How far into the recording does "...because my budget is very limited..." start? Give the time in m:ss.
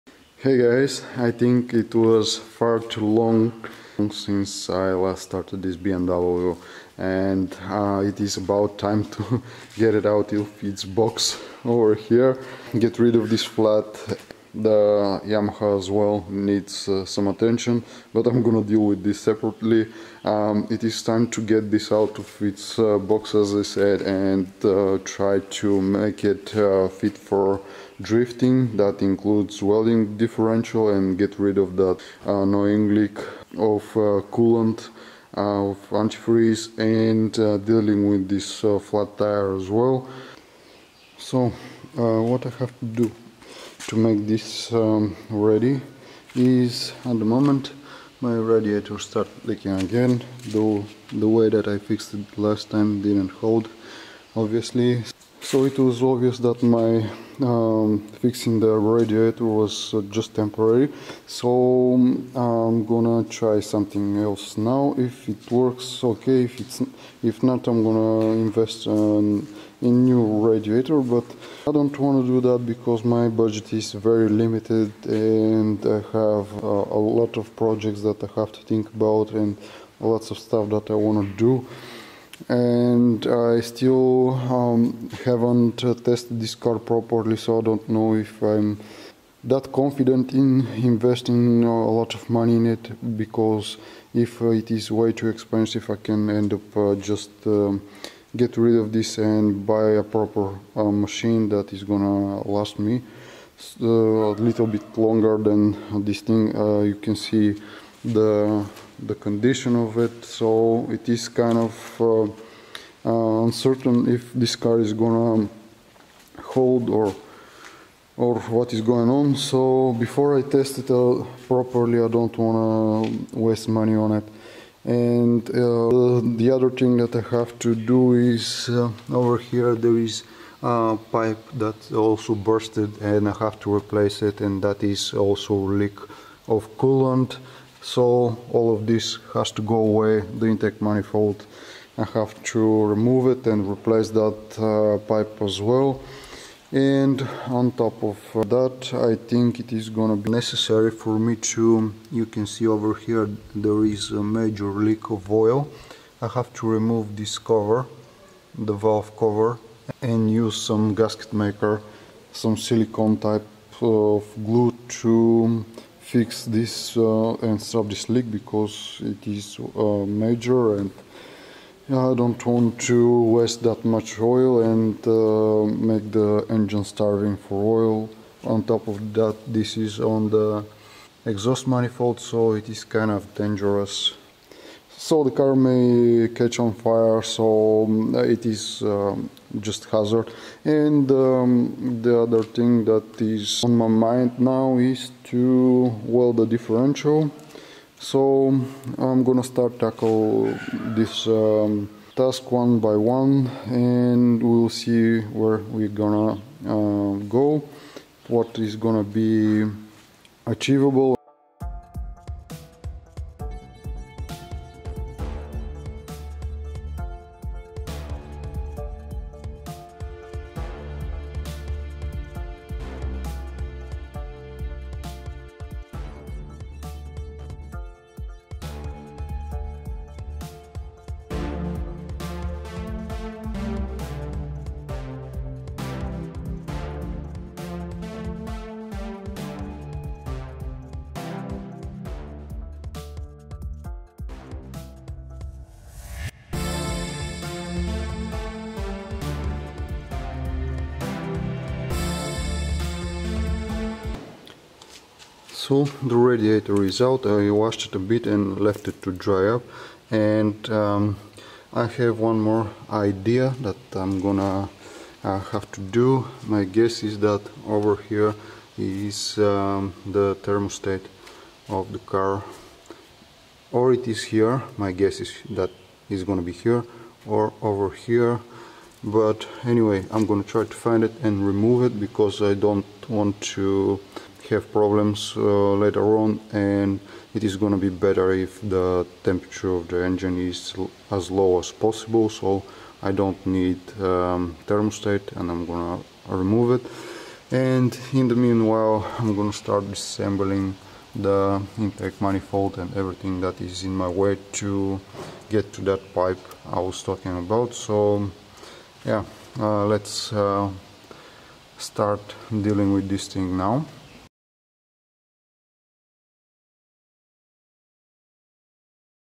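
1:12.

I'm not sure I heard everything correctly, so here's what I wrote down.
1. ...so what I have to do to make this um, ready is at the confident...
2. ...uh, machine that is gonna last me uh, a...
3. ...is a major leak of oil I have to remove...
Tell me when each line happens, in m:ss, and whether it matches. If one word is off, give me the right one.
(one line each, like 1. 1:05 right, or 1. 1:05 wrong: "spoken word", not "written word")
1. 0:41 wrong: "moment", not "confident"
2. 1:40 right
3. 2:33 right.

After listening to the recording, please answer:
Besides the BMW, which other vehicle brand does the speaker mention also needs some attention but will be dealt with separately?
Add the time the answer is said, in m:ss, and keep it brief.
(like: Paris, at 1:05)
Yamaha, at 0:15.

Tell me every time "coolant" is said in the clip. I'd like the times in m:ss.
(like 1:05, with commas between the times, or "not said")
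0:34, 2:16.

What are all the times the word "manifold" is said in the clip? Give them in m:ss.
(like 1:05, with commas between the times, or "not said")
2:20, 3:01, 5:02.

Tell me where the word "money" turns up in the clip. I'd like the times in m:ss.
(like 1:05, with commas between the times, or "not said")
1:32, 2:03.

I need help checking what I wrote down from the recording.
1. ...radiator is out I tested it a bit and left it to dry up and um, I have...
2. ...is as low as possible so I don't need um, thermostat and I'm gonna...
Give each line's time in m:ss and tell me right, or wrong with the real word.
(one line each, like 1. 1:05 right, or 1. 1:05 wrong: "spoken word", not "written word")
1. 4:16 wrong: "washed", not "tested"
2. 4:50 right.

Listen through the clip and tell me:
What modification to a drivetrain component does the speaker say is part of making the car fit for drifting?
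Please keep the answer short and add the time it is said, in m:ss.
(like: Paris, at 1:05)
welding differential, at 0:29.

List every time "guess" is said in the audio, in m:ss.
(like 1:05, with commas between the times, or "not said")
4:26, 4:34.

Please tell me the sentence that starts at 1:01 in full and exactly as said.
So um, I'm gonna try something else now.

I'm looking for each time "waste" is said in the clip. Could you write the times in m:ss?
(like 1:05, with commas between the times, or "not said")
2:03, 2:53.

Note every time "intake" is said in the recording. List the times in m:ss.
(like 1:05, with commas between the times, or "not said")
2:20, 5:01.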